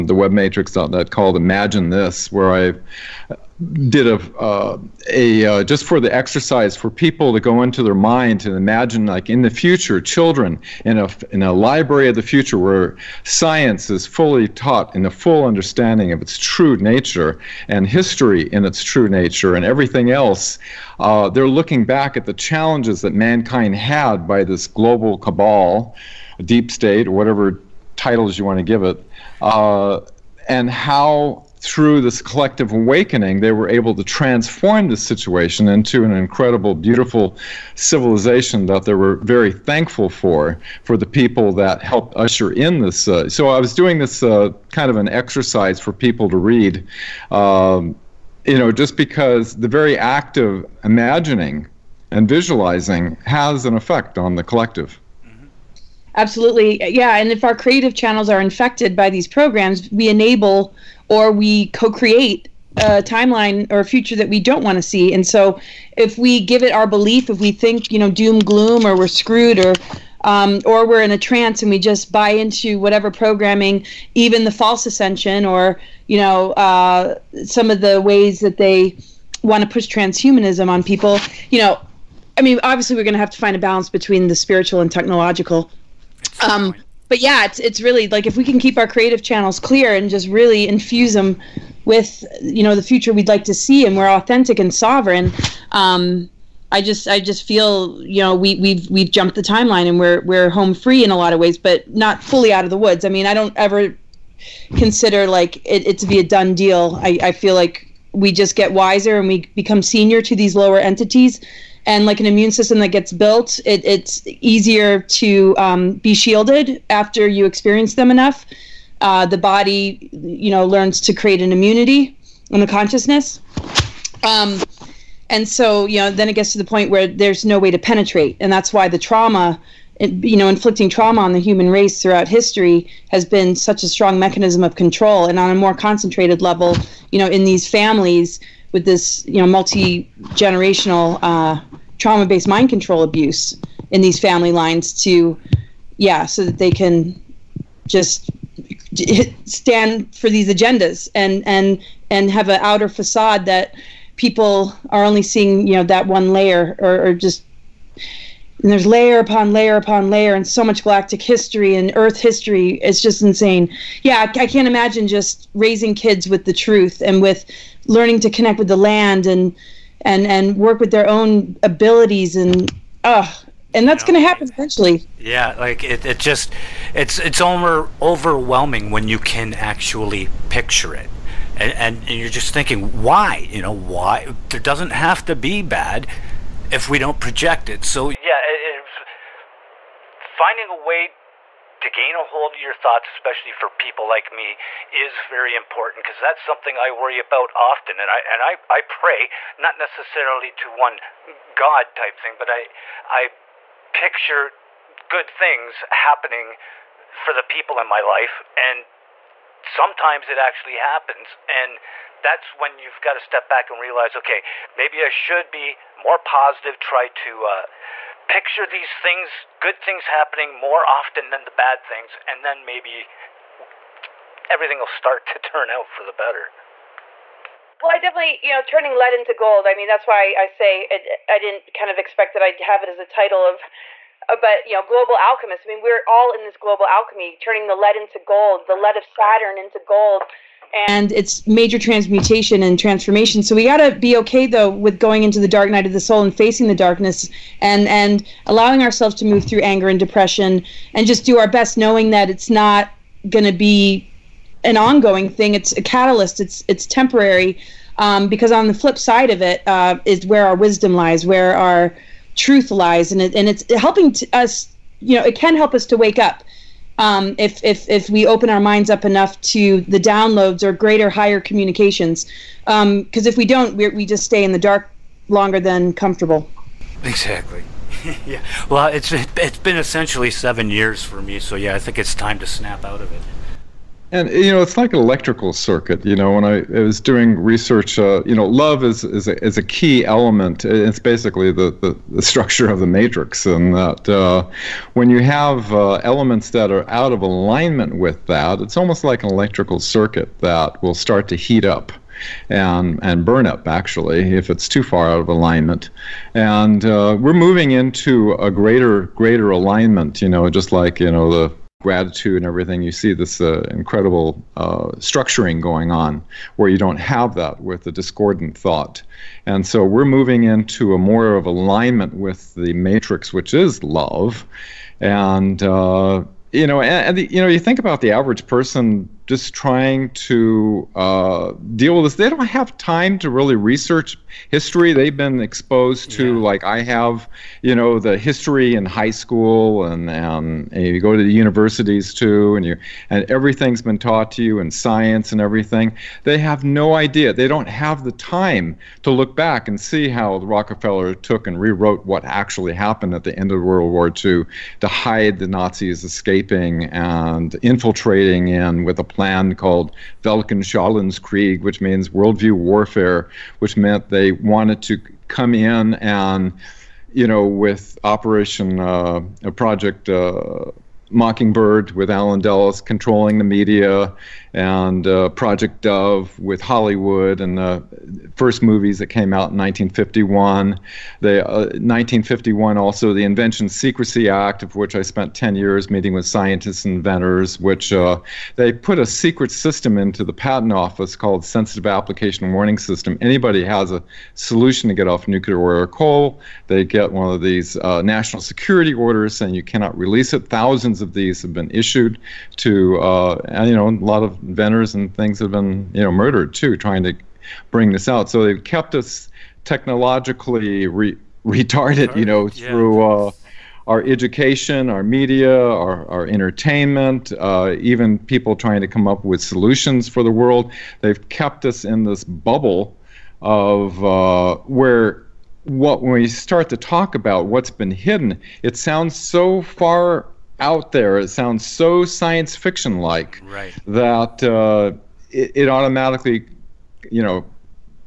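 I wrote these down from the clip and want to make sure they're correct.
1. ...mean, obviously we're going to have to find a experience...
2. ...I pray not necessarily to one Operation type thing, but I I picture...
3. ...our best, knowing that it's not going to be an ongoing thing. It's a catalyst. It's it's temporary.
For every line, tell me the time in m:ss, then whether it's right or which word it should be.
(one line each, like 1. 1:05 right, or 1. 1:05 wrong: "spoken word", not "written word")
1. 1:22 wrong: "balance", not "experience"
2. 3:18 wrong: "God", not "Operation"
3. 4:11 right.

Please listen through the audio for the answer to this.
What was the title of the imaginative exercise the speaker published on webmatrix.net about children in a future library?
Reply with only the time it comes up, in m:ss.
0:01.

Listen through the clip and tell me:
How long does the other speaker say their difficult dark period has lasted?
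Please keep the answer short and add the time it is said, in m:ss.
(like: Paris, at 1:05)
7 years, at 4:40.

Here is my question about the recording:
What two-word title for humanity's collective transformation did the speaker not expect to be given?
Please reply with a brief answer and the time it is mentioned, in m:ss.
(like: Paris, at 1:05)
global alchemists, at 3:54.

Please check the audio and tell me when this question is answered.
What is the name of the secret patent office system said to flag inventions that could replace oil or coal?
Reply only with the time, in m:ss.
6:31.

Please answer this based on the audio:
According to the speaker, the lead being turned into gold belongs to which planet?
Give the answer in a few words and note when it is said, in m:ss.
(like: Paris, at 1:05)
Saturn, at 3:59.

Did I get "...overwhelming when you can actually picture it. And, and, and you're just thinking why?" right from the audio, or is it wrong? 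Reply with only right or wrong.
right.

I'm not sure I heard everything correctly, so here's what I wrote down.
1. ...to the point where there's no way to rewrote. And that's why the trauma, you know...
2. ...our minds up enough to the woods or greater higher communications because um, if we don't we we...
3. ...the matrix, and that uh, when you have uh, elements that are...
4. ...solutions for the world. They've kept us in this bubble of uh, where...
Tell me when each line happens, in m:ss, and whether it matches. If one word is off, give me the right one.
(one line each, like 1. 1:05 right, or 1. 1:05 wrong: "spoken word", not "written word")
1. 2:06 wrong: "penetrate", not "rewrote"
2. 4:28 wrong: "downloads", not "woods"
3. 4:52 right
4. 6:59 right.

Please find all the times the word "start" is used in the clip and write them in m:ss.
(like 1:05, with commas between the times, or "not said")
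3:44, 5:00, 7:06.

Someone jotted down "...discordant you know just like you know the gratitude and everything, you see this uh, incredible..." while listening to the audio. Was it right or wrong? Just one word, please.
wrong.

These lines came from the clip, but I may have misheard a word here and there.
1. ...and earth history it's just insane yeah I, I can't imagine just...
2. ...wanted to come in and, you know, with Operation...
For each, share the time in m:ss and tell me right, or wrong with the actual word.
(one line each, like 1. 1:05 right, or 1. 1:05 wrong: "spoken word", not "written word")
1. 2:41 right
2. 6:04 right.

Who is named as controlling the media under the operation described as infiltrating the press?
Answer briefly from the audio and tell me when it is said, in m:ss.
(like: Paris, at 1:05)
Allen Dulles, at 6:12.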